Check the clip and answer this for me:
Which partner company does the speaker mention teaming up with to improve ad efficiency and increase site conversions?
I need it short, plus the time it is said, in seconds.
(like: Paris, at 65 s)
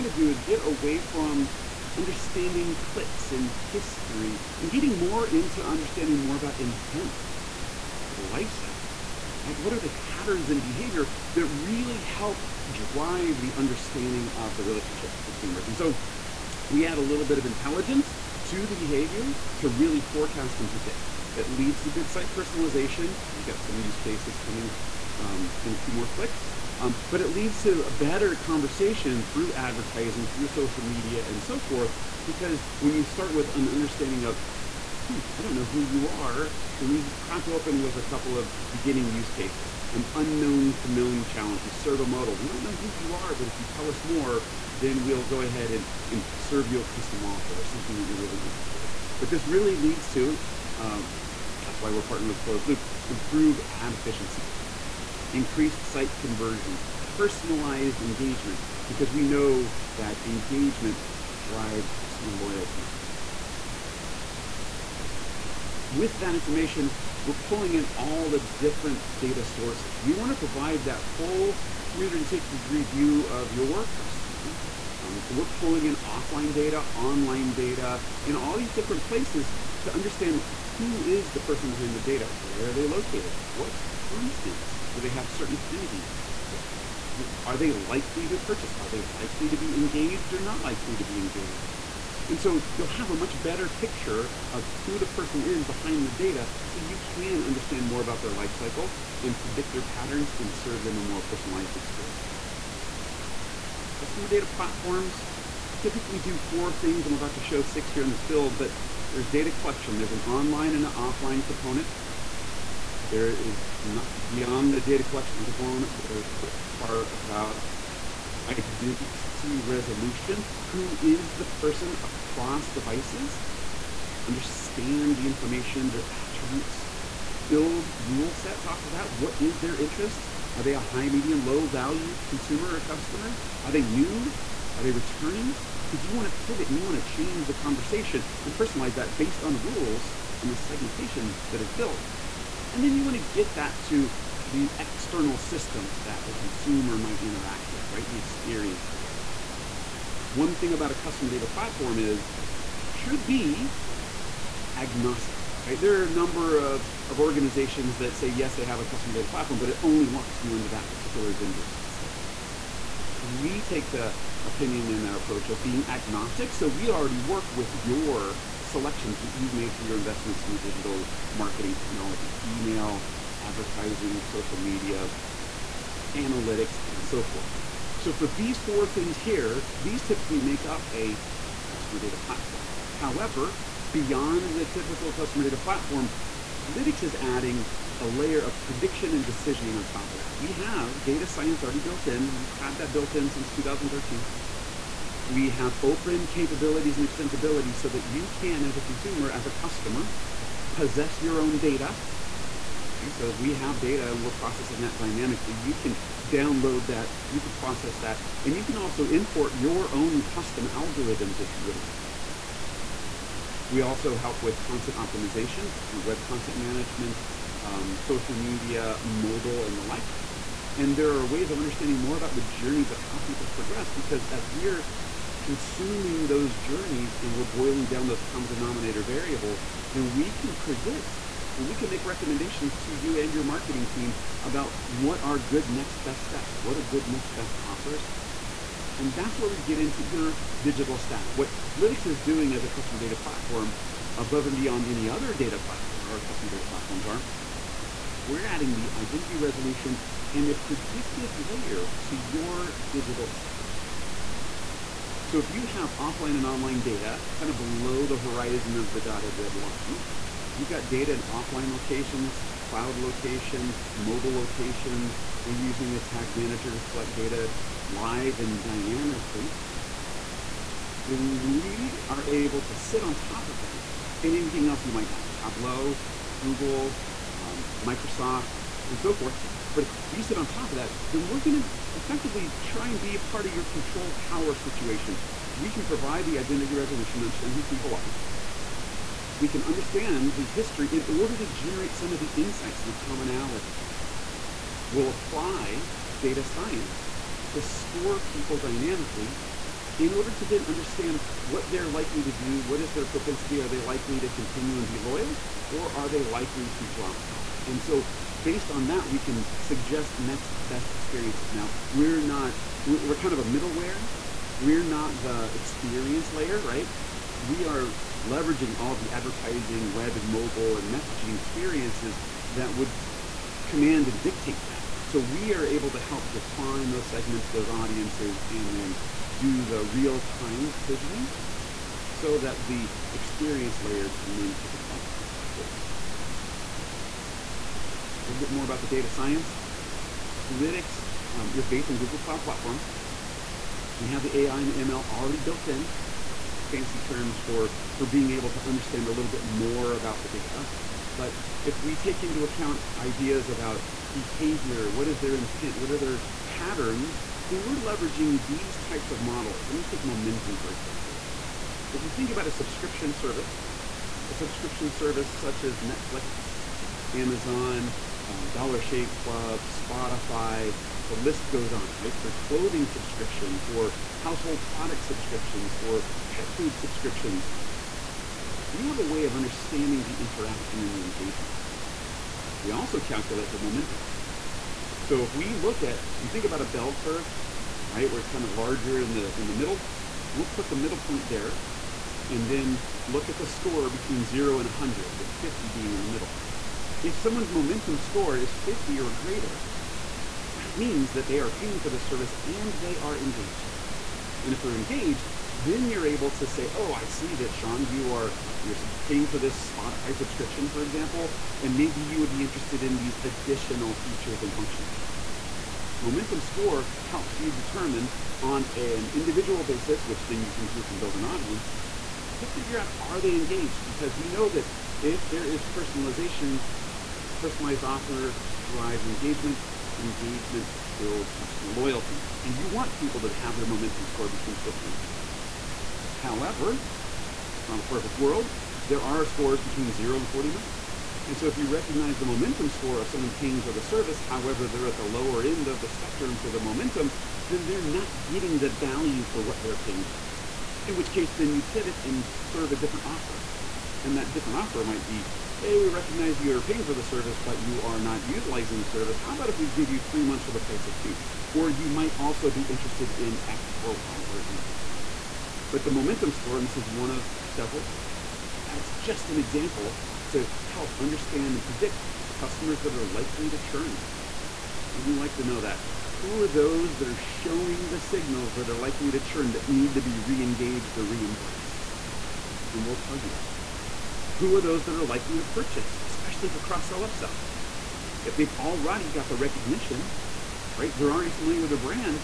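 Closed Loop, at 52 s.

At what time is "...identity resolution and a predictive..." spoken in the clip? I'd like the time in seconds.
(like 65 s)
248 s.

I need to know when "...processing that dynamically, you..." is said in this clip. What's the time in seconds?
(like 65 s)
204 s.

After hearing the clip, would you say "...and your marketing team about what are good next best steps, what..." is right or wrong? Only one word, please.
right.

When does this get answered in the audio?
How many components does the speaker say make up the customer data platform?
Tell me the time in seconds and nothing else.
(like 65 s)
107 s.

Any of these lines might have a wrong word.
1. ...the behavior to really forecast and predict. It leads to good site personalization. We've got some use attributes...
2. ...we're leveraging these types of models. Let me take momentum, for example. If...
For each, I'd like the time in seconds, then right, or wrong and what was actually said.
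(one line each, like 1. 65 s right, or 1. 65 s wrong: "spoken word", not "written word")
1. 18 s wrong: "cases", not "attributes"
2. 357 s right.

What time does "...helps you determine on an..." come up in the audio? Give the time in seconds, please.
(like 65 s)
417 s.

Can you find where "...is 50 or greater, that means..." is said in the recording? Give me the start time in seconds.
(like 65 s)
398 s.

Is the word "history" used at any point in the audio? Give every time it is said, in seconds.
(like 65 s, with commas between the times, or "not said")
3 s, 290 s.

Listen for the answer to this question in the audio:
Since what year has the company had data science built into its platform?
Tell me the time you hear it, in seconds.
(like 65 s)
193 s.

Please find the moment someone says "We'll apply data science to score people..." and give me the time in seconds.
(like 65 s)
294 s.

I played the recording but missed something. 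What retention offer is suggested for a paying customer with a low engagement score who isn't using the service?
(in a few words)
3 months for the price of 2.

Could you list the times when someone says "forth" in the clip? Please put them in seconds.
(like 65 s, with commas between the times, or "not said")
31 s, 177 s, 279 s.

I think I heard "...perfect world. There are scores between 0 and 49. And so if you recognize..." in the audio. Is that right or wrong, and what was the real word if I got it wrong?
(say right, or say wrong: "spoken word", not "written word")
right.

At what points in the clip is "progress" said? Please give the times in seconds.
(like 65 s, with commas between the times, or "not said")
223 s.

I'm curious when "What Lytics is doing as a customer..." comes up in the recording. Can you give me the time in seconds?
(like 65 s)
241 s.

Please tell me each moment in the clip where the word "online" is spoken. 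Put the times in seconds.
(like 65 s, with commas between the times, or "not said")
76 s, 110 s, 256 s.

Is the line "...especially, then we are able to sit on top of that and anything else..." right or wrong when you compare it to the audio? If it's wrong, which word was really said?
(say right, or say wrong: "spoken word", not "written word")
wrong: "dynamically", not "especially".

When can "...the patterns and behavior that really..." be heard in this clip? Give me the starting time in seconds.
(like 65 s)
9 s.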